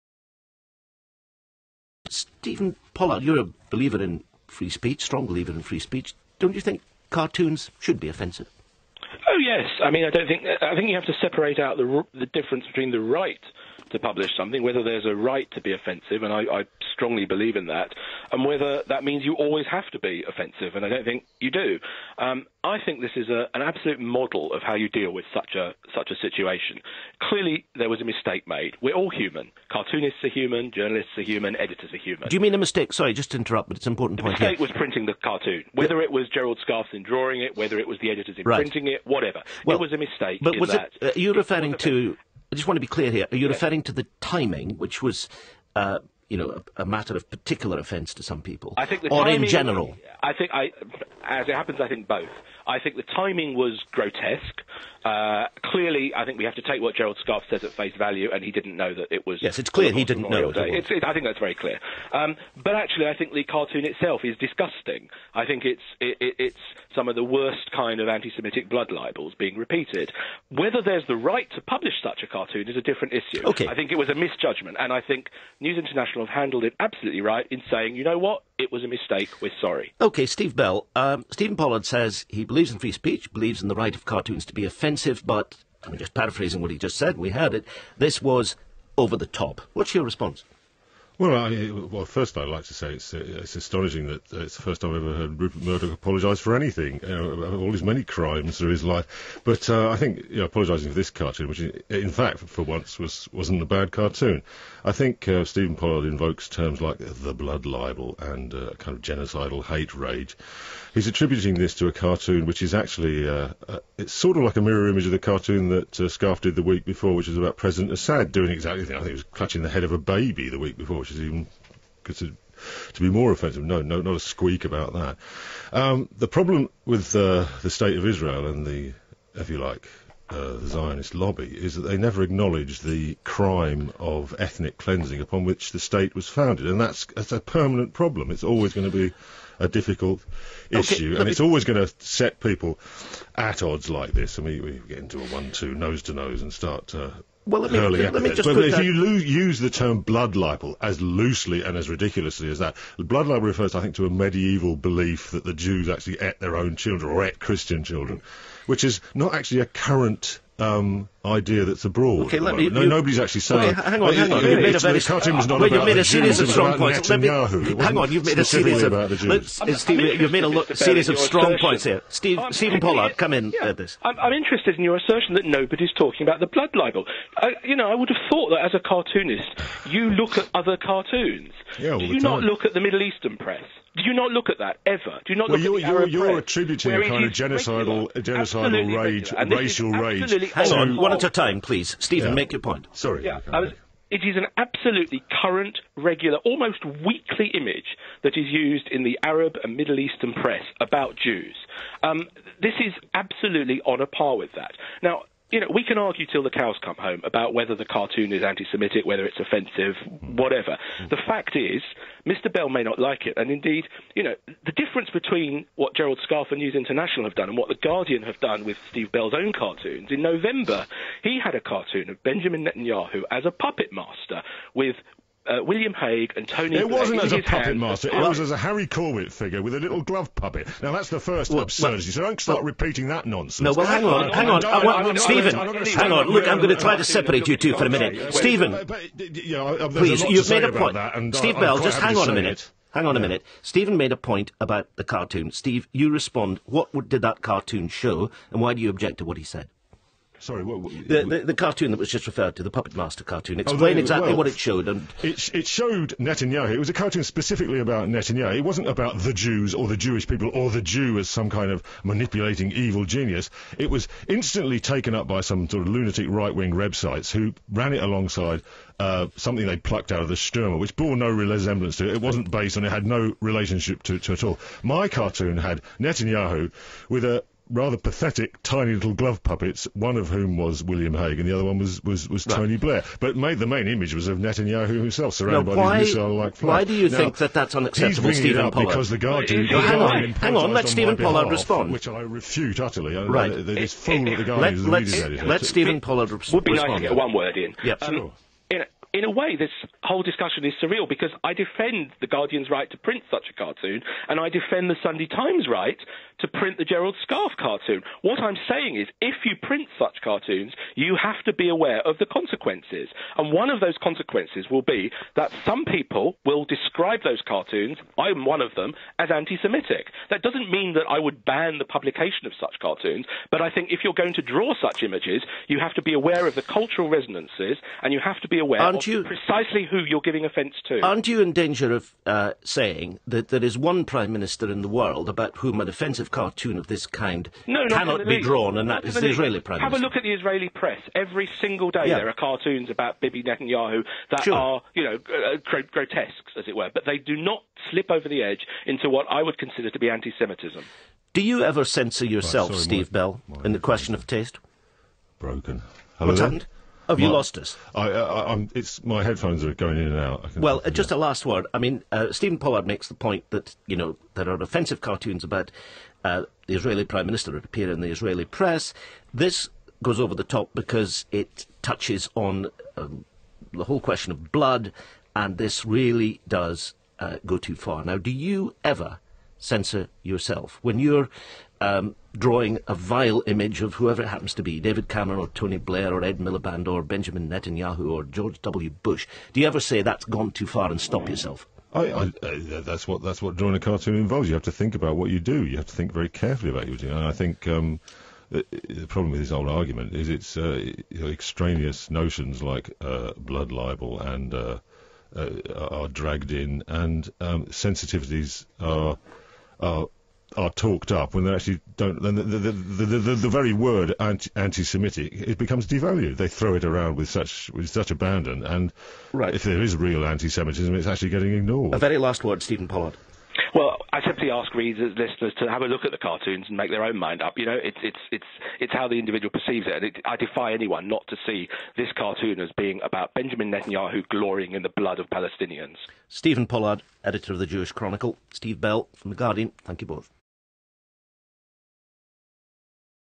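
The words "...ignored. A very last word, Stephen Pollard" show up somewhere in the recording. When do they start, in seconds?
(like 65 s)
421 s.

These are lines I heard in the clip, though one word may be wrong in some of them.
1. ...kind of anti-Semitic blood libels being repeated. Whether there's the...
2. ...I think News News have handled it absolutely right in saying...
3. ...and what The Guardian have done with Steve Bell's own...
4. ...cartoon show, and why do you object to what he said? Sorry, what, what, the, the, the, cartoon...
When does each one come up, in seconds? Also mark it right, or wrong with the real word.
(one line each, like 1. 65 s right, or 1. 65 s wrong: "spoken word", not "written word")
1. 67 s right
2. 74 s wrong: "International", not "News"
3. 217 s right
4. 247 s right.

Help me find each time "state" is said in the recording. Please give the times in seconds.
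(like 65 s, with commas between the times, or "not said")
127 s, 135 s.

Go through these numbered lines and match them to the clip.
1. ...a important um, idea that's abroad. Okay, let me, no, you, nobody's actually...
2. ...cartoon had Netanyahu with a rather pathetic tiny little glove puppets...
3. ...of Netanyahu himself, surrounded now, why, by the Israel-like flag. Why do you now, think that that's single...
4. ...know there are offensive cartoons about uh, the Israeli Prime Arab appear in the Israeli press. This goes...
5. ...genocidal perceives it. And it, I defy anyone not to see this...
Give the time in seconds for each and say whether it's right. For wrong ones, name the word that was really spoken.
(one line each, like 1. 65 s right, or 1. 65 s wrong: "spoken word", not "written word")
1. 159 s wrong: "current", not "important"
2. 275 s right
3. 284 s wrong: "unacceptable", not "single"
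4. 363 s wrong: "Minister", not "Arab"
5. 429 s wrong: "individual", not "genocidal".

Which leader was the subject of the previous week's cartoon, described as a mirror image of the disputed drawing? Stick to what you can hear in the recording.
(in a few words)
President Assad.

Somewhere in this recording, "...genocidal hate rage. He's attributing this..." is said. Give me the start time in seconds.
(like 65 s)
109 s.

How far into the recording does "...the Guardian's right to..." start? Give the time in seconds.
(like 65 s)
302 s.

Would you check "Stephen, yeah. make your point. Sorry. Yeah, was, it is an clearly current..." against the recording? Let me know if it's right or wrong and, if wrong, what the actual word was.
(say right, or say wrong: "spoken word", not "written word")
wrong: "absolutely", not "clearly".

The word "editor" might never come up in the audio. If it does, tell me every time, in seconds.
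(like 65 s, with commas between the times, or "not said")
31 s, 38 s, 295 s, 437 s.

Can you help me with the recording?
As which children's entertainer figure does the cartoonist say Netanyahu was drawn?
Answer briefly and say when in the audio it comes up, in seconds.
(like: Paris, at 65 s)
Harry Corbett, at 228 s.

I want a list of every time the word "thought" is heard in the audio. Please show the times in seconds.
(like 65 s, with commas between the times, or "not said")
178 s.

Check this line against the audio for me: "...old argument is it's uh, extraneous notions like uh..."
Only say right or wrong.
right.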